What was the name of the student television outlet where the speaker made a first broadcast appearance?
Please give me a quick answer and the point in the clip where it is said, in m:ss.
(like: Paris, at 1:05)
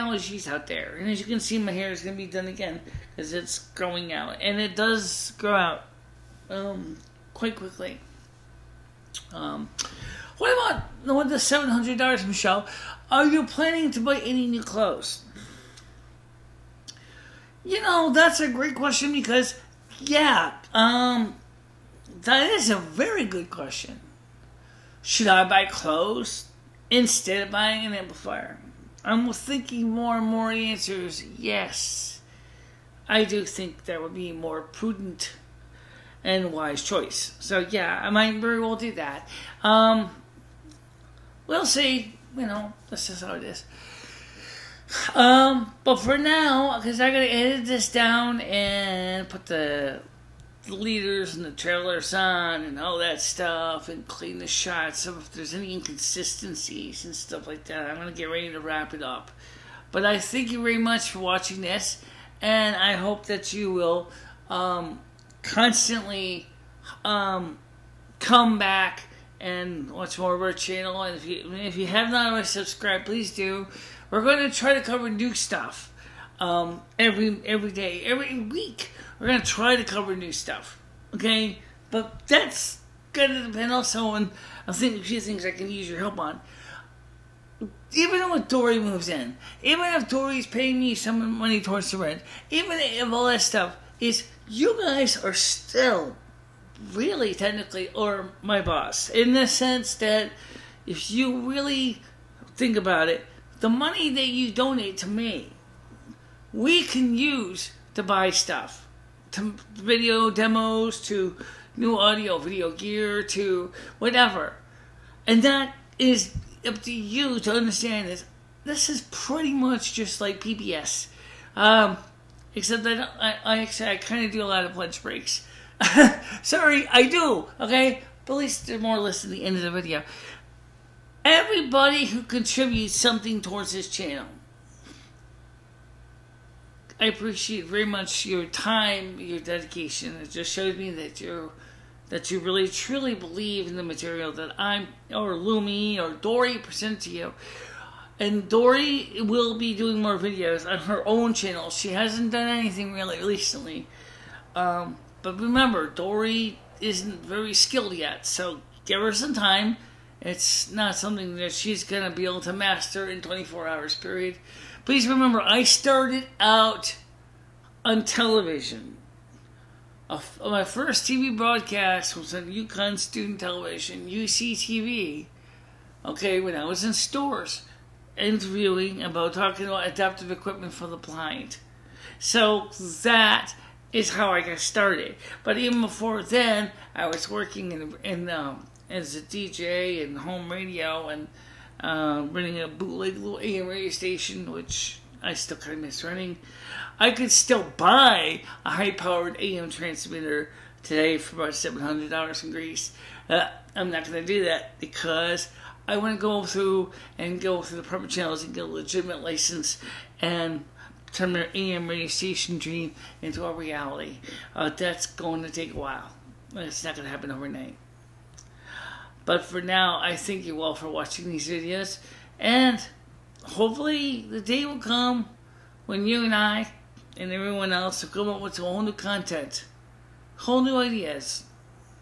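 UConn Student Television, at 2:52.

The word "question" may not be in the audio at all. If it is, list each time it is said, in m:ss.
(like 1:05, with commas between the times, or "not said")
0:18, 0:23.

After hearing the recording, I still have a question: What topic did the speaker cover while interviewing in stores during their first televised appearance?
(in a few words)
adaptive equipment for the blind.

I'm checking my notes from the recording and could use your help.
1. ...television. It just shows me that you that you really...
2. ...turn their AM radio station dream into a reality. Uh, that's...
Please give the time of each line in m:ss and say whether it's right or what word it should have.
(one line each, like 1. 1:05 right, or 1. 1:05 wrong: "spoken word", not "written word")
1. 2:19 wrong: "dedication", not "television"
2. 3:31 right.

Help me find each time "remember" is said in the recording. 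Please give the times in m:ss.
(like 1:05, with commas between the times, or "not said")
2:35, 2:45.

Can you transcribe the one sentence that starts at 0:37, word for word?
So yeah, I might very well do that.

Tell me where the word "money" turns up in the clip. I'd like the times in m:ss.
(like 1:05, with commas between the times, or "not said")
1:31, 1:43.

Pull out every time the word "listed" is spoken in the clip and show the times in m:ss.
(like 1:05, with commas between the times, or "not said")
2:08.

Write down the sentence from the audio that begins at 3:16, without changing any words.
I could still buy a high powered AM transmitter today for about $700 in Greece.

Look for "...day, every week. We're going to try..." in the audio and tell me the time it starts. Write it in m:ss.
1:17.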